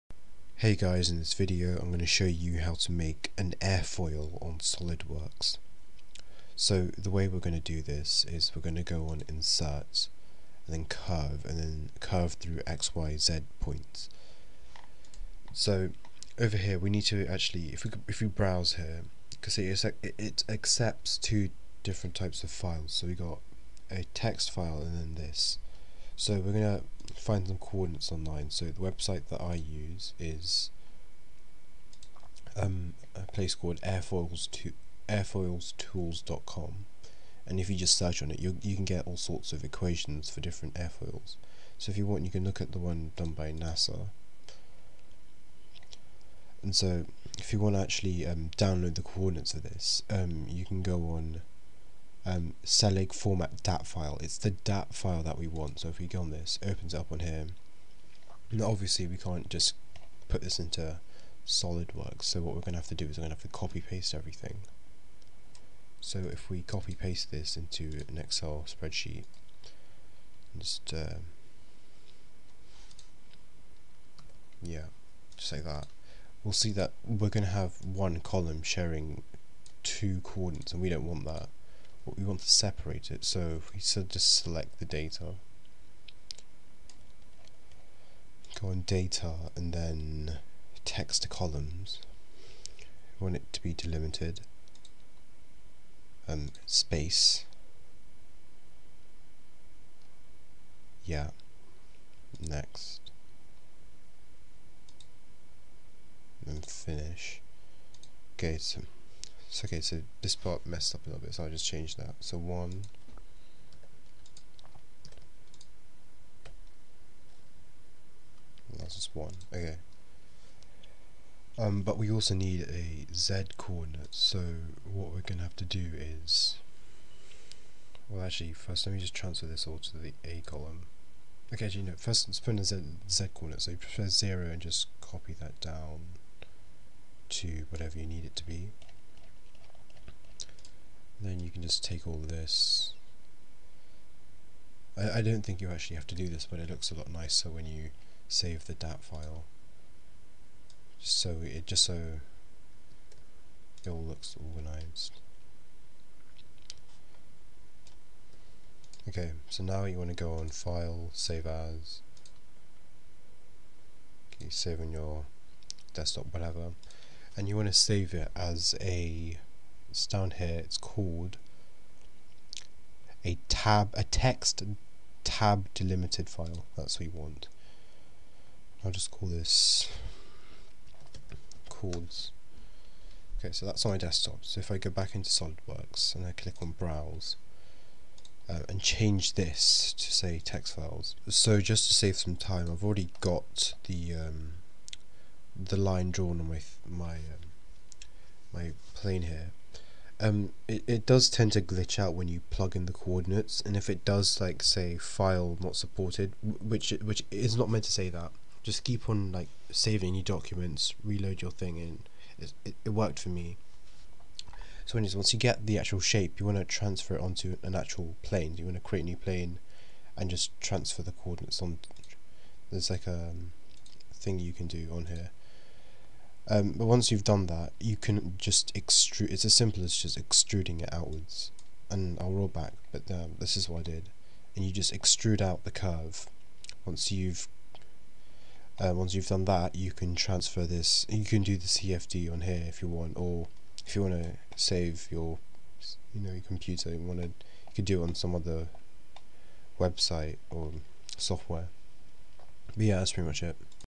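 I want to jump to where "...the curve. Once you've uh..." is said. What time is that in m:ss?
3:55.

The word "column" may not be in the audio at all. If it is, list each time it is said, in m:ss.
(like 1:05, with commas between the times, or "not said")
1:18, 1:31, 2:10.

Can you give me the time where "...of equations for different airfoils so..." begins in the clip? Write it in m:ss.
0:39.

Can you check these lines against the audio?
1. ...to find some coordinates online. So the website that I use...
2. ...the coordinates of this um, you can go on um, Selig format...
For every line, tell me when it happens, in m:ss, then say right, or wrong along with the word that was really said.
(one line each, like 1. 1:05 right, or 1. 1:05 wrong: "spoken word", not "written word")
1. 0:26 right
2. 0:48 right.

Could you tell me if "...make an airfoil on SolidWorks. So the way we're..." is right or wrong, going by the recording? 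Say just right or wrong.
right.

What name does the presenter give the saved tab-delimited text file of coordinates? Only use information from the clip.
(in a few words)
chords.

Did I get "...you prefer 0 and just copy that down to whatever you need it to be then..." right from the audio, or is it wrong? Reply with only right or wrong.
right.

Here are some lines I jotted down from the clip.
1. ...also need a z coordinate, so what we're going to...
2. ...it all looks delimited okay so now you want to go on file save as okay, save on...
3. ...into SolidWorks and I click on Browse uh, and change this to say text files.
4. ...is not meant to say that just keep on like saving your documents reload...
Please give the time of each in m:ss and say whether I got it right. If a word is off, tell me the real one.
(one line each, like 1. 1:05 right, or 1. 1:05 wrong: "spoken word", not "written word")
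1. 2:02 right
2. 2:33 wrong: "organized", not "delimited"
3. 3:05 right
4. 3:27 right.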